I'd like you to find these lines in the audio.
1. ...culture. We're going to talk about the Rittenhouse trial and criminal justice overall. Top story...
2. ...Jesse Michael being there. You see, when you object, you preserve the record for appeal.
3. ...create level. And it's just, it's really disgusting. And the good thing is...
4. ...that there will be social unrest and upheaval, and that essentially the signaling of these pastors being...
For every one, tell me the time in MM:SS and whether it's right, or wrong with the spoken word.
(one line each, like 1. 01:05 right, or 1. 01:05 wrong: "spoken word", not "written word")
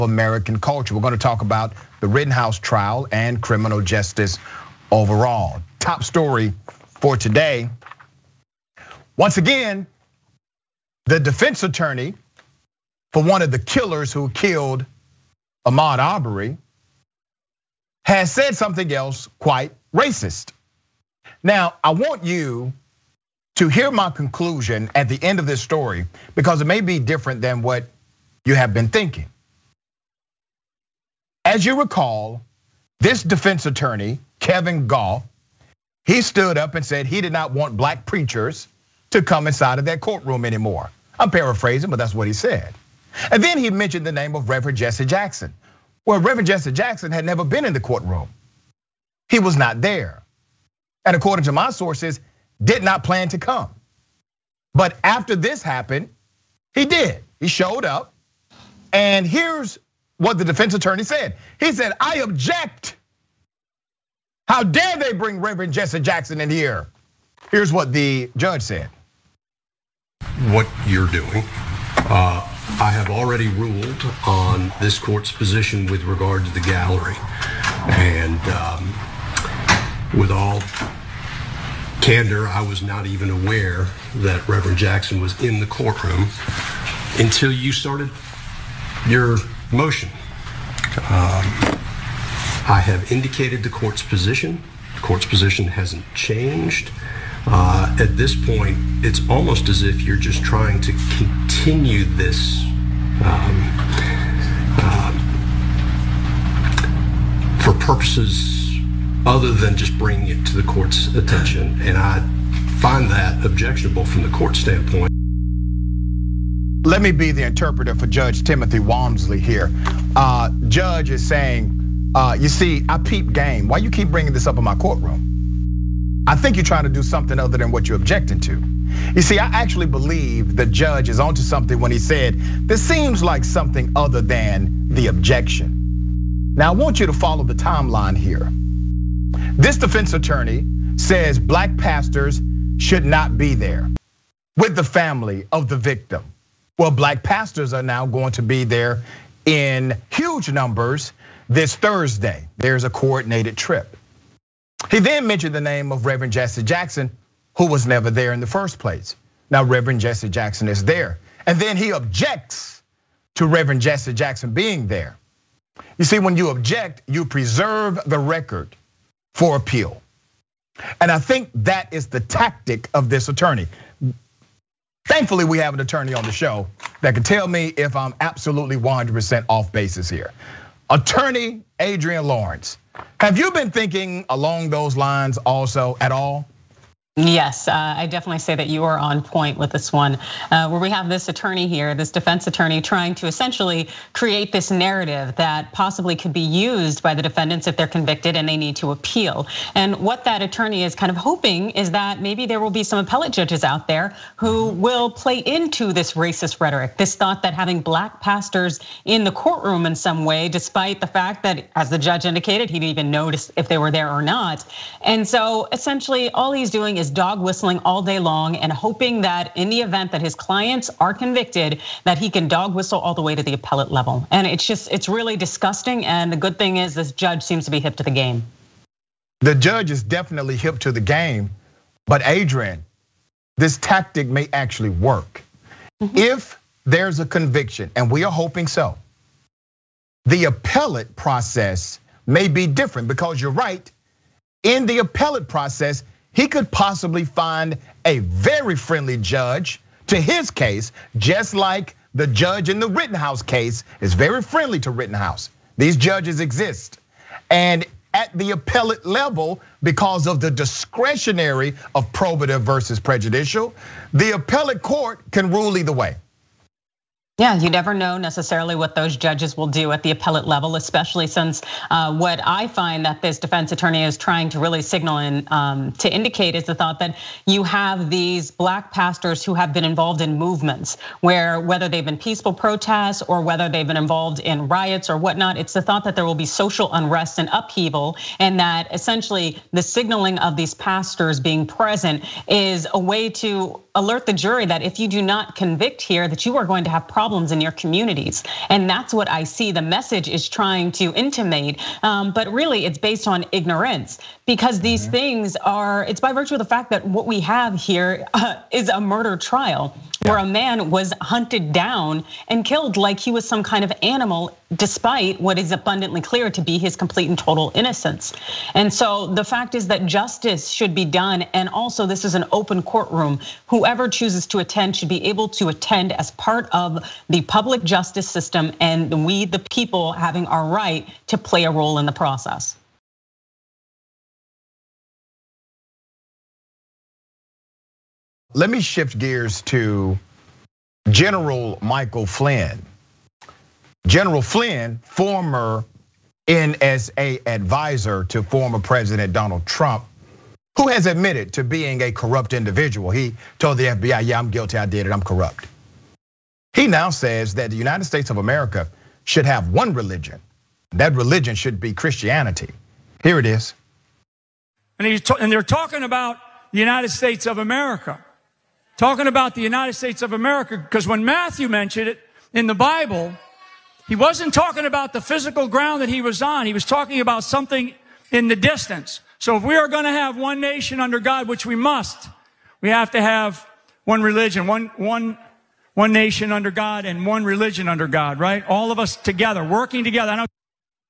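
1. 00:00 right
2. 02:43 wrong: "Jackson", not "Michael"
3. 03:43 wrong: "appellate", not "create"
4. 04:46 right.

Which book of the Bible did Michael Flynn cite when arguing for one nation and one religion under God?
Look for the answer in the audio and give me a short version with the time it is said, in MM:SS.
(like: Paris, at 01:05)
Matthew, at 06:11.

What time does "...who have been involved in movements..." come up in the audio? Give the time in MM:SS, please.
04:39.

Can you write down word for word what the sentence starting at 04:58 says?
And that's what I see the message is trying to intimate.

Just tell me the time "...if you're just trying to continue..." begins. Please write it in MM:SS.
01:39.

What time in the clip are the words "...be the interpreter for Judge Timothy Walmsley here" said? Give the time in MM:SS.
01:57.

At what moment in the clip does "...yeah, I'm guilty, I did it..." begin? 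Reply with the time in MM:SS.
05:54.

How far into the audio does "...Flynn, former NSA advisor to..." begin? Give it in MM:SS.
05:44.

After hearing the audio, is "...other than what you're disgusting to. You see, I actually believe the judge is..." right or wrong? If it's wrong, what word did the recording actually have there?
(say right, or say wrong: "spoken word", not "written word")
wrong: "objecting", not "disgusting".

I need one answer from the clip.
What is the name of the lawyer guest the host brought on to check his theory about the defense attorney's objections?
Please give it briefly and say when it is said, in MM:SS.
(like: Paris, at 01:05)
Adrienne Lawrence, at 03:00.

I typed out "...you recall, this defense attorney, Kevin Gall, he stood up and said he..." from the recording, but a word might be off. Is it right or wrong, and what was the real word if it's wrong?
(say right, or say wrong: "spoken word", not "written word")
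right.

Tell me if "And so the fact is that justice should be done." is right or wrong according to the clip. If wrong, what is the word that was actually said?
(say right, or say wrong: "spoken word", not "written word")
right.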